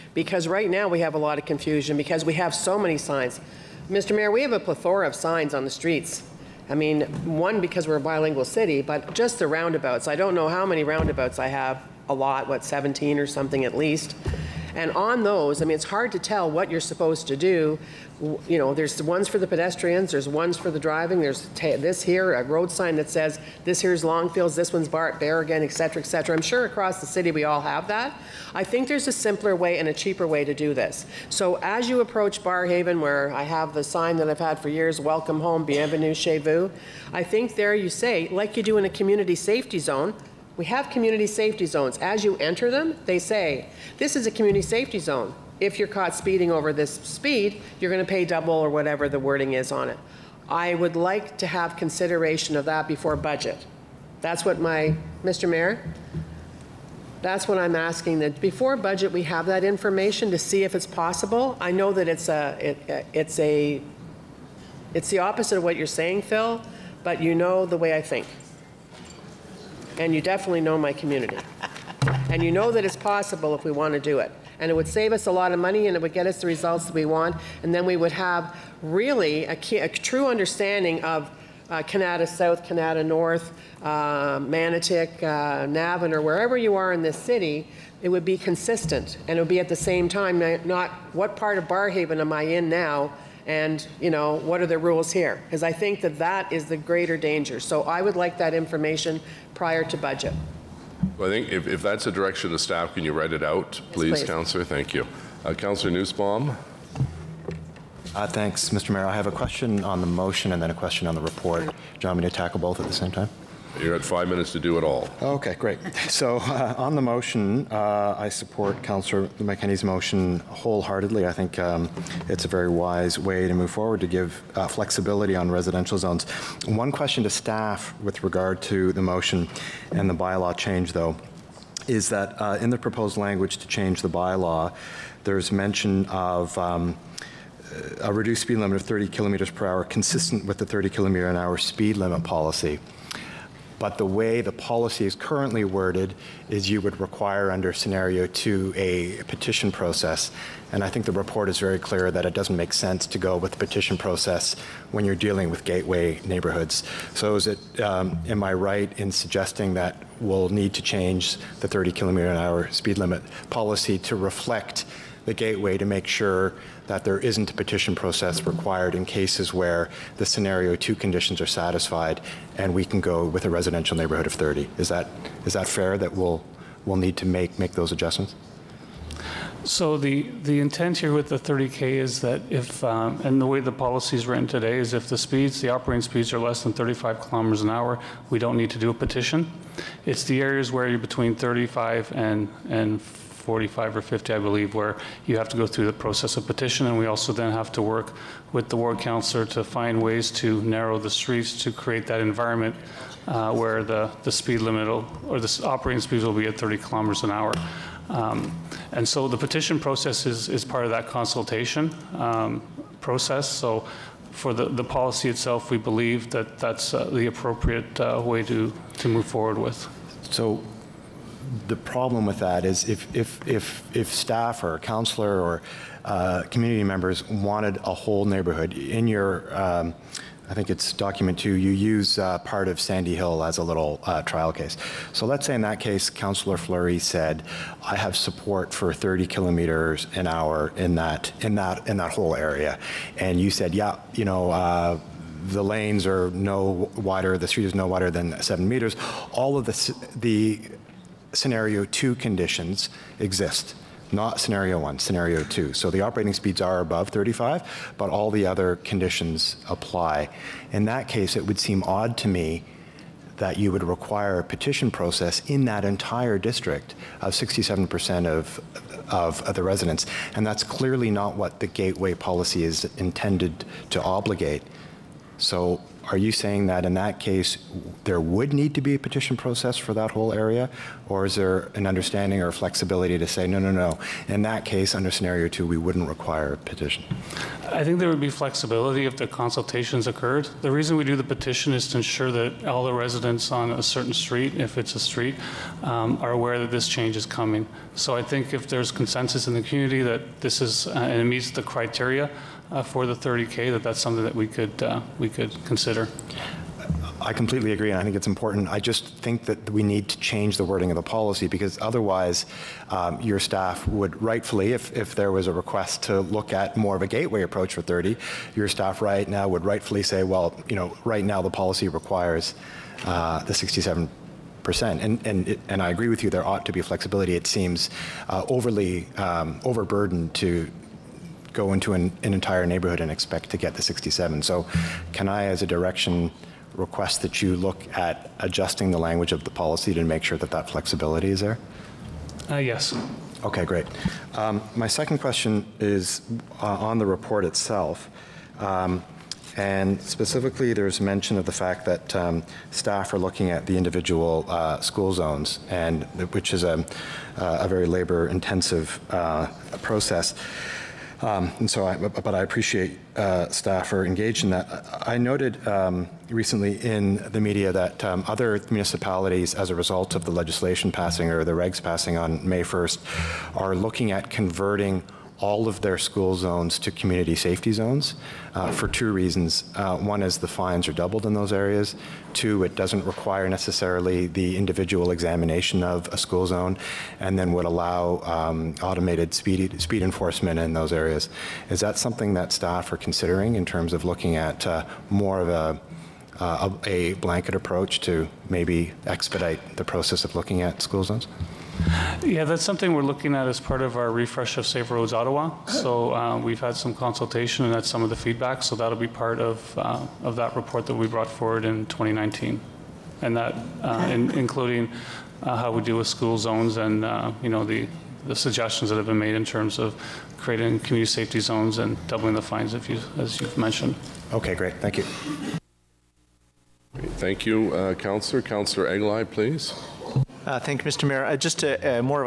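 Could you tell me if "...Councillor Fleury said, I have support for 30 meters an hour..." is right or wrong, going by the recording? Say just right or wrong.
wrong.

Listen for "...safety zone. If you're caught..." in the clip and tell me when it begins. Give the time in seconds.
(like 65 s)
44 s.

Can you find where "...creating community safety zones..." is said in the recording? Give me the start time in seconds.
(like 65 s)
420 s.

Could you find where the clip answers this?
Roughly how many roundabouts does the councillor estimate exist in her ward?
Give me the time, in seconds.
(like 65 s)
12 s.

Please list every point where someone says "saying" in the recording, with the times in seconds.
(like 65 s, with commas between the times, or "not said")
65 s, 276 s.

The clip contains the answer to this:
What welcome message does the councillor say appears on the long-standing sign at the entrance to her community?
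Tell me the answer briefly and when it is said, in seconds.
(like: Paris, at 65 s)
Welcome home, at 35 s.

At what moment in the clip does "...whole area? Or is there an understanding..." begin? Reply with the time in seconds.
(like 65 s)
280 s.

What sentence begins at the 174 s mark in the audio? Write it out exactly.
Is that, is that fair that we'll, we'll need to make, make those adjustments?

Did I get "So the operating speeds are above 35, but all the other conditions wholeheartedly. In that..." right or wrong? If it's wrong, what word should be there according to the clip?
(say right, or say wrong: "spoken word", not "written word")
wrong: "apply", not "wholeheartedly".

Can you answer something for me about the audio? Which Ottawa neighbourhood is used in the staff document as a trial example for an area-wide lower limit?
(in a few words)
Sandy Hill.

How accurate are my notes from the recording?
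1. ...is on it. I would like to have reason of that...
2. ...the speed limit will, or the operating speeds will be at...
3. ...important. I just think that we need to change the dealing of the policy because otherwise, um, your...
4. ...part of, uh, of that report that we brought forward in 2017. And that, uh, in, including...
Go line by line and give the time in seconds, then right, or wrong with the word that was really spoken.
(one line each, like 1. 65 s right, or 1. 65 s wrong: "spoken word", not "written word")
1. 49 s wrong: "consideration", not "reason"
2. 204 s right
3. 308 s wrong: "wording", not "dealing"
4. 409 s wrong: "2019", not "2017".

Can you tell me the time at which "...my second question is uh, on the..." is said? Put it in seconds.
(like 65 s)
344 s.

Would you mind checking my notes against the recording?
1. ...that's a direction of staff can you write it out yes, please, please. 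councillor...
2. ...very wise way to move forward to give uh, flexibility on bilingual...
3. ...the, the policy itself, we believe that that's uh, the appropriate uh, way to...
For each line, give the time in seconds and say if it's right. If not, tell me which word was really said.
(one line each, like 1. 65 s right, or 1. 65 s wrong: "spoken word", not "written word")
1. 101 s right
2. 122 s wrong: "residential", not "bilingual"
3. 214 s right.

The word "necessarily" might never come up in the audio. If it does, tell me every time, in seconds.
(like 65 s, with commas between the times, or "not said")
383 s.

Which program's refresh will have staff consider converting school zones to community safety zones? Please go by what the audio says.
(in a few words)
Safe Roads Ottawa.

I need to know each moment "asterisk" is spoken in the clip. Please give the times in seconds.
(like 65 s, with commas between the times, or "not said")
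not said.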